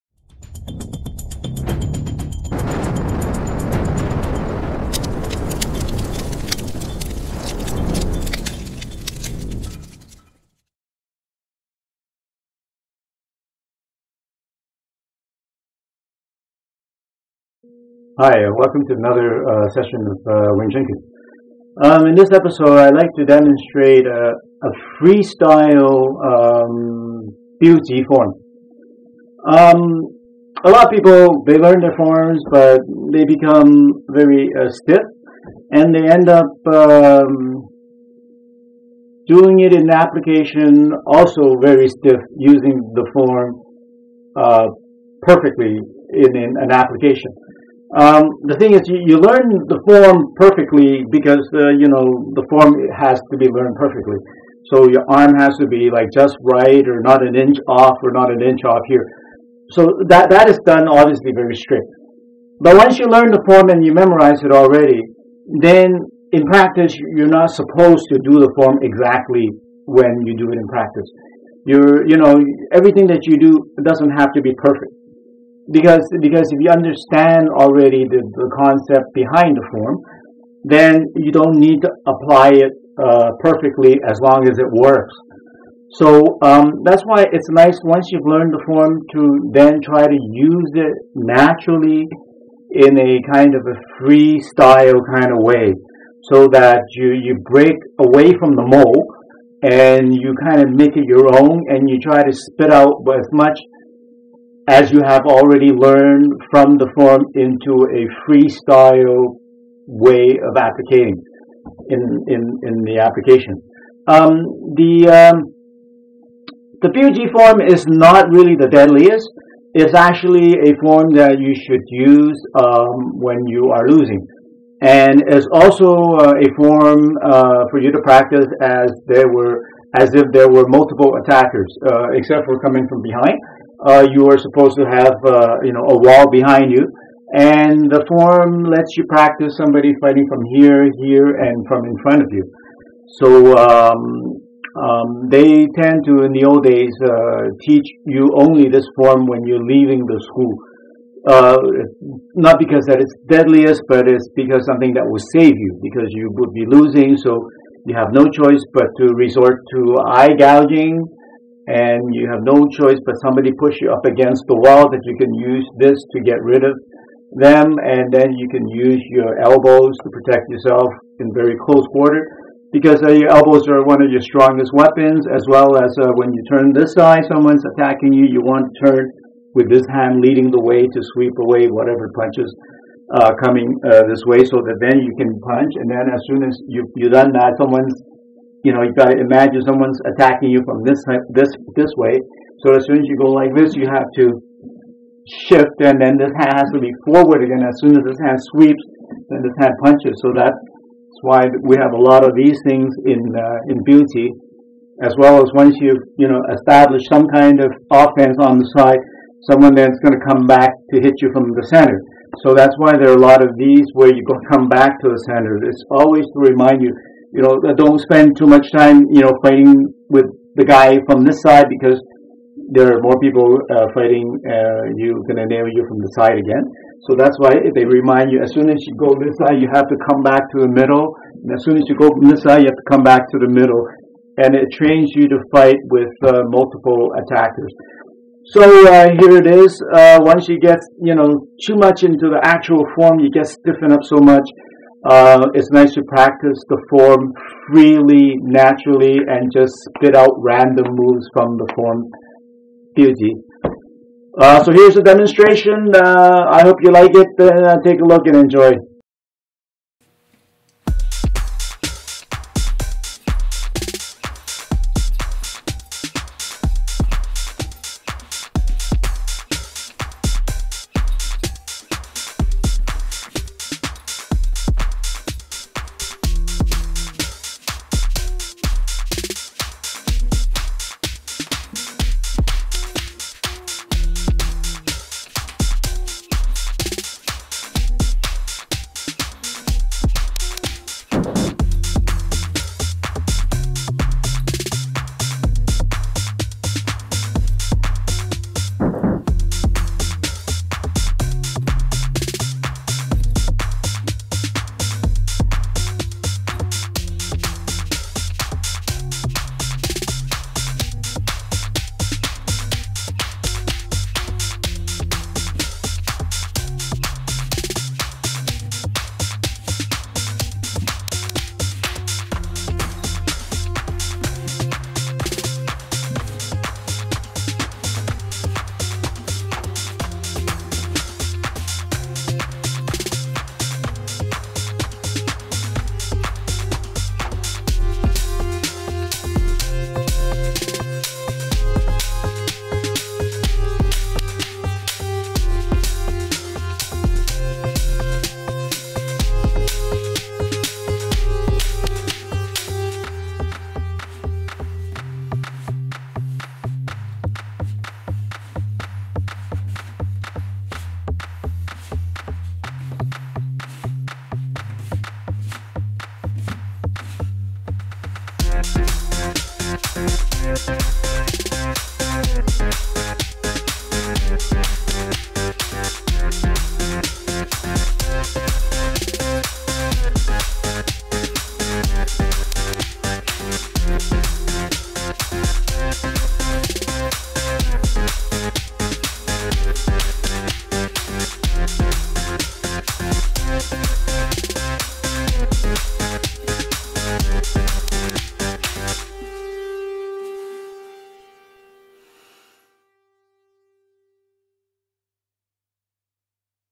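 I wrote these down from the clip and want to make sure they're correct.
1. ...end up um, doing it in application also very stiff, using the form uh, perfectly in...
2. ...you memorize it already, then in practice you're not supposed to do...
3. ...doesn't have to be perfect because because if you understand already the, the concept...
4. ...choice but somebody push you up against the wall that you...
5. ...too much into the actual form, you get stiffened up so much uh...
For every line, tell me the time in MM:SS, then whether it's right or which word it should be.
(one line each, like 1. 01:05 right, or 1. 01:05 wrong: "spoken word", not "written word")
1. 00:36 right
2. 01:03 right
3. 01:13 right
4. 02:42 right
5. 04:01 right.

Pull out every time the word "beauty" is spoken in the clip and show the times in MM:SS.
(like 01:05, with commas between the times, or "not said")
not said.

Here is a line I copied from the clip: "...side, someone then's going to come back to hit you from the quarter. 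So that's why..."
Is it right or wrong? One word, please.
wrong.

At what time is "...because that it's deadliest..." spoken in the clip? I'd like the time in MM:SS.
02:32.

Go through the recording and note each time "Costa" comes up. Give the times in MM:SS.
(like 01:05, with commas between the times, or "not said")
not said.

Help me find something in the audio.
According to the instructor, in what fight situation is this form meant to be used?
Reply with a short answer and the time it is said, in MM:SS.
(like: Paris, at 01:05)
when you are losing, at 02:03.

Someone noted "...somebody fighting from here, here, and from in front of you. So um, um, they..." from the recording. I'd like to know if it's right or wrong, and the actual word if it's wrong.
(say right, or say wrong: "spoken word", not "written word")
right.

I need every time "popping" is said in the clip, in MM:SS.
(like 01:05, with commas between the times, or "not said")
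not said.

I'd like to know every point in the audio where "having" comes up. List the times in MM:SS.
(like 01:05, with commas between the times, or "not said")
not said.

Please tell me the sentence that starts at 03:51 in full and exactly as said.
And as soon as you go from this side, you have to come back to the middle.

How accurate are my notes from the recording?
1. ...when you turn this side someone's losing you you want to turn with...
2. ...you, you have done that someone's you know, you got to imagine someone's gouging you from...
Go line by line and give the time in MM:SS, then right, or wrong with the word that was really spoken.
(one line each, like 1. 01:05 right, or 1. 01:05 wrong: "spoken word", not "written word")
1. 02:56 wrong: "attacking", not "losing"
2. 03:06 wrong: "attacking", not "gouging".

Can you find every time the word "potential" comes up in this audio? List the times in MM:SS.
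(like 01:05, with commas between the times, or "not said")
not said.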